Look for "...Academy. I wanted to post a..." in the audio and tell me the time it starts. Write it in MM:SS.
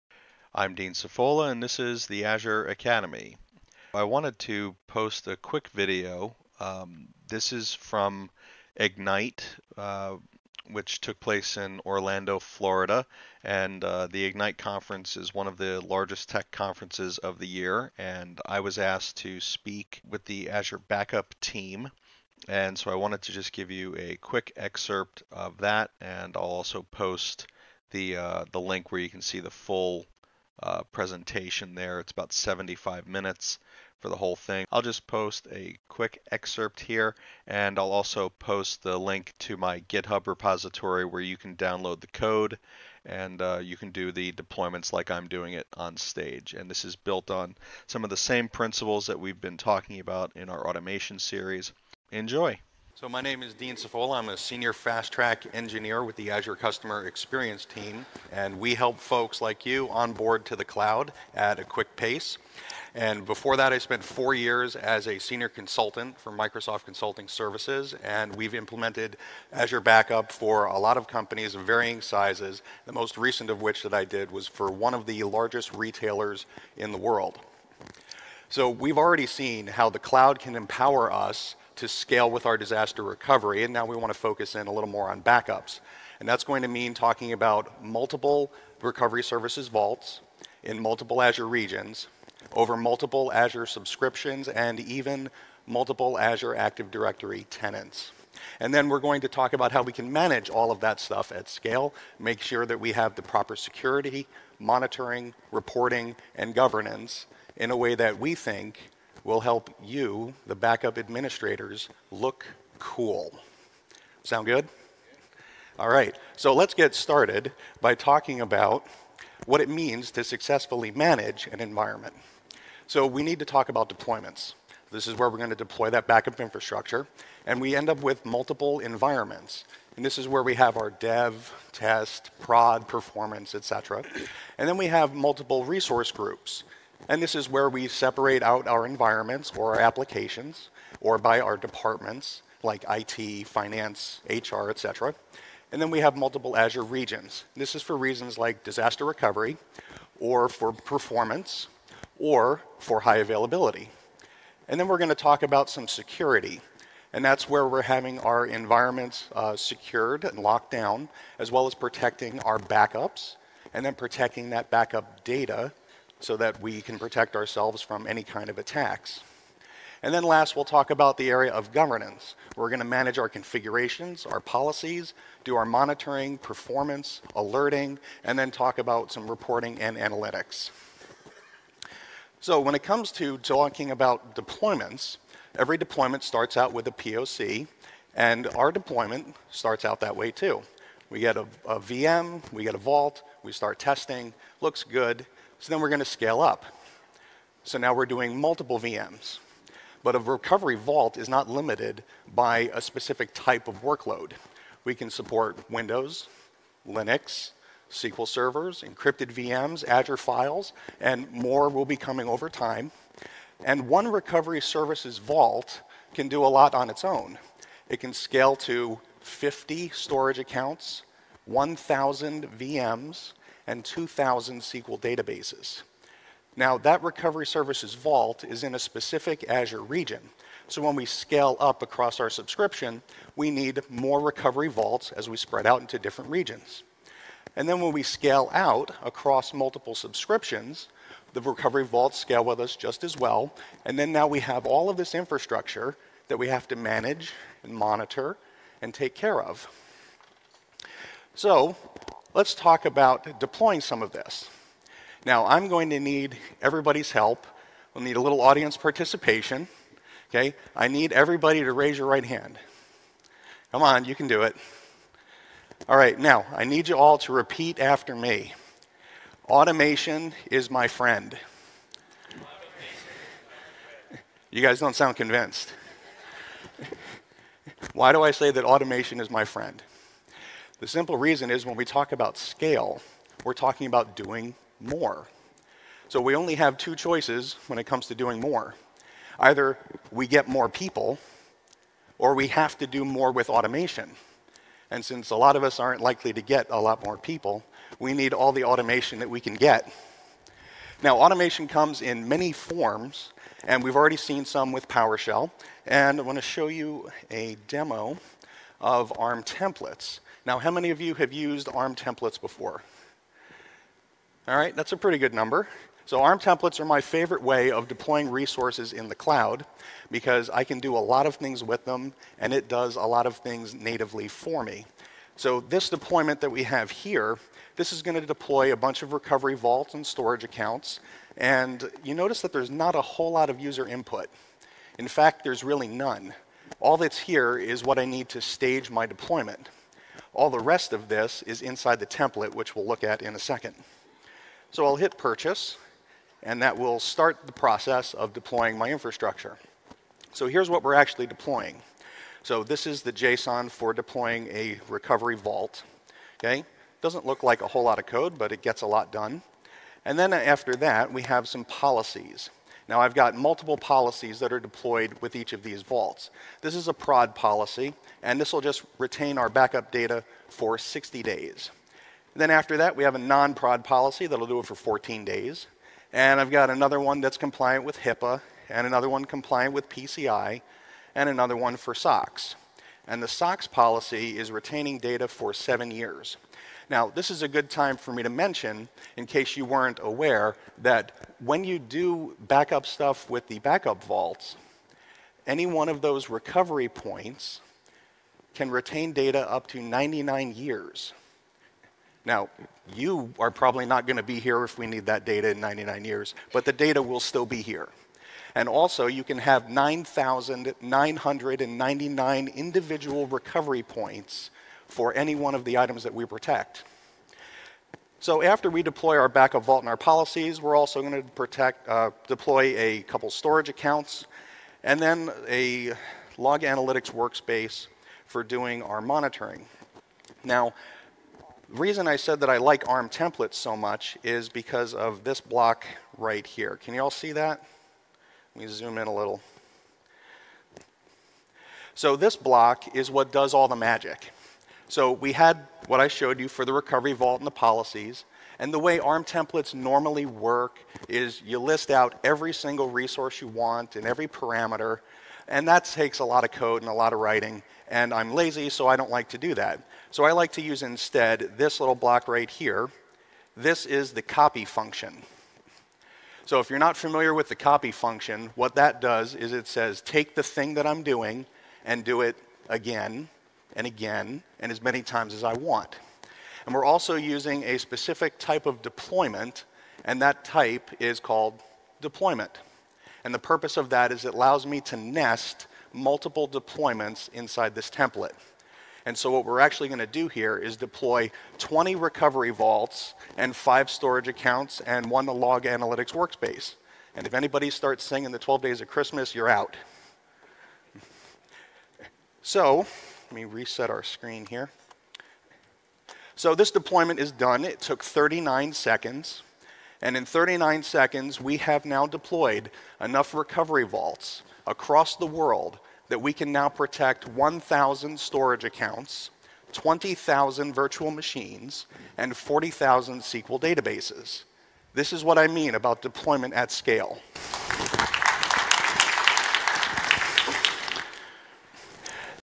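00:02.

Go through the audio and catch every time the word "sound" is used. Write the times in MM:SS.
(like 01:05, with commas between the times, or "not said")
01:54, 04:34.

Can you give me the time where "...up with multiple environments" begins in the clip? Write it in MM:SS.
02:07.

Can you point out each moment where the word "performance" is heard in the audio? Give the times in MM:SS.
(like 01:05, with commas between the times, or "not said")
02:12, 02:30, 02:56.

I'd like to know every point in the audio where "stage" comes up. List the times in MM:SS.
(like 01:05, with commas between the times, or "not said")
00:45, 05:38.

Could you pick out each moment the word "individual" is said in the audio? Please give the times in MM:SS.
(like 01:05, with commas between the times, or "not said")
06:52.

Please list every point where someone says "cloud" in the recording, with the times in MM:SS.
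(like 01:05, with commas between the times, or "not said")
01:00, 01:19, 05:19.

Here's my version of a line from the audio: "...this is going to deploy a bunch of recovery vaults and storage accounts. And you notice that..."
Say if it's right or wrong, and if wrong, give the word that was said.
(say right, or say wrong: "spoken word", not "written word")
right.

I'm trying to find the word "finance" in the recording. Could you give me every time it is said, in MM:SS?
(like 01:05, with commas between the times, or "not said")
02:23.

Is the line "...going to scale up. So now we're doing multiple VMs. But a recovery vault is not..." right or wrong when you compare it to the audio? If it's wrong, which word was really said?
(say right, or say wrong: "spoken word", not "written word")
right.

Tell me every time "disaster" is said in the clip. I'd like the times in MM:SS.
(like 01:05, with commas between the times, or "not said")
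01:22, 02:28.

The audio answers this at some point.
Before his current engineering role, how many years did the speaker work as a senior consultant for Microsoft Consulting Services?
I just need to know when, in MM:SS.
01:04.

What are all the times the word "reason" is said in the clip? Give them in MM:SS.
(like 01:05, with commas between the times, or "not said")
02:27, 04:41, 07:11.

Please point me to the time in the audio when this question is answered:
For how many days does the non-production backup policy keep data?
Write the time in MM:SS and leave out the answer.
06:14.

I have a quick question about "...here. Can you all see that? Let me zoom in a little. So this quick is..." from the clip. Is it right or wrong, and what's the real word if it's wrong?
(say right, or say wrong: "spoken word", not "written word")
wrong: "block", not "quick".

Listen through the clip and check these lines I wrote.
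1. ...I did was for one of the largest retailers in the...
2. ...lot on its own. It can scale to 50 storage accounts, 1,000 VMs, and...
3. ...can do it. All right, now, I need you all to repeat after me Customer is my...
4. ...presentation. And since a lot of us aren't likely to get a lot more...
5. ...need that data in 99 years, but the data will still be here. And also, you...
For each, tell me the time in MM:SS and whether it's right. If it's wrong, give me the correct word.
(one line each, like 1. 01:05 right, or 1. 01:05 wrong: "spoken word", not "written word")
1. 01:13 right
2. 03:36 right
3. 04:24 wrong: "Automation", not "Customer"
4. 04:53 wrong: "automation", not "presentation"
5. 06:44 right.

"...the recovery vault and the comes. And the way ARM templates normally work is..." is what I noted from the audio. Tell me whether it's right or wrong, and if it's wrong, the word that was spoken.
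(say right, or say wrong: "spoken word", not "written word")
wrong: "policies", not "comes".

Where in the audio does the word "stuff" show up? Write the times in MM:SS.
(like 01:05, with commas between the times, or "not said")
01:40, 06:32.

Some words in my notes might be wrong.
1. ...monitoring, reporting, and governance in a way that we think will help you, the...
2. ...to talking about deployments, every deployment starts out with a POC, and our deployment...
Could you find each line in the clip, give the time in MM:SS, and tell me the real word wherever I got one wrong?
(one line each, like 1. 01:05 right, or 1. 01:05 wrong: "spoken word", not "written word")
1. 01:44 right
2. 03:03 right.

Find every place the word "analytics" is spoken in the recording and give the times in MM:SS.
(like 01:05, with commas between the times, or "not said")
02:59, 07:06, 08:15.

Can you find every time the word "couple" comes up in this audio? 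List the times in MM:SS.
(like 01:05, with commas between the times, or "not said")
07:03.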